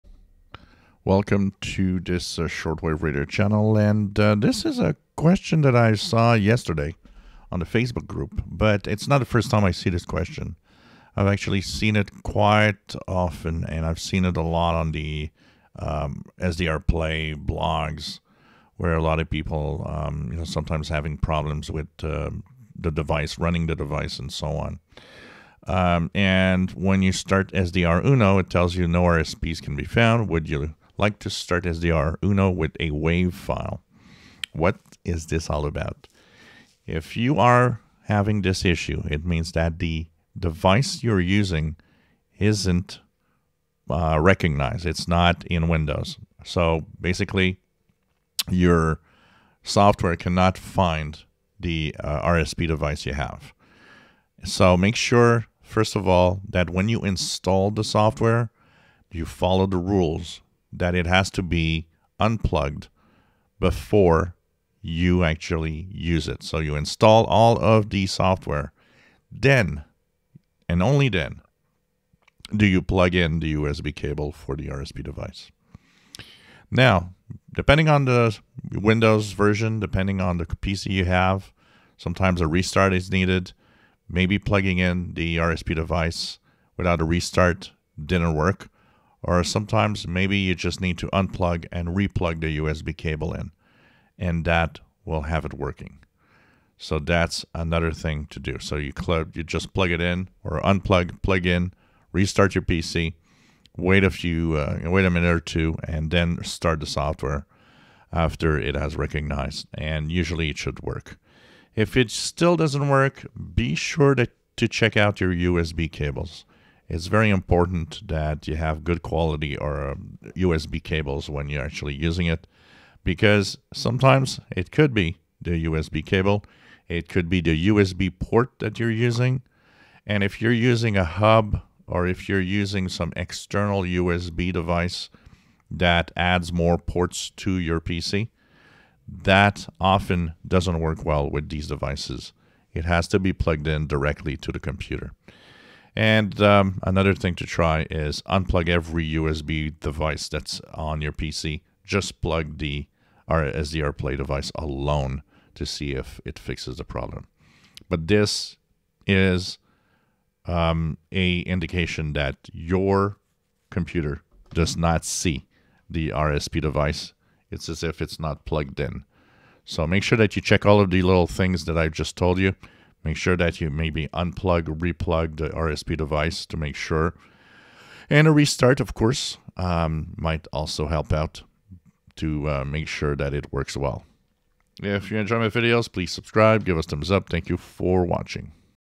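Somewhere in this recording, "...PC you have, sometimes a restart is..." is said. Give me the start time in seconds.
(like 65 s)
80 s.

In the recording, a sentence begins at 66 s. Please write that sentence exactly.
So you install all of the software.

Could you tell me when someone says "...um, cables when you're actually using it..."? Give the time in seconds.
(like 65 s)
120 s.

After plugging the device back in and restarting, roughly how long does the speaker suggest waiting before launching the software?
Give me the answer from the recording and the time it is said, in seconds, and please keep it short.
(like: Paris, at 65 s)
A minute or two, at 105 s.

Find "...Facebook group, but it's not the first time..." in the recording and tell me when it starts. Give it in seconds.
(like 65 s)
7 s.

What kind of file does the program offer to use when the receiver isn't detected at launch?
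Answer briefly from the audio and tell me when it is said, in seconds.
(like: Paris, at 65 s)
WAV file, at 32 s.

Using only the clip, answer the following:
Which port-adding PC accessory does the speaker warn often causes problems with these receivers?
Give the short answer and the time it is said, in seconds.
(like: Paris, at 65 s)
A hub, at 130 s.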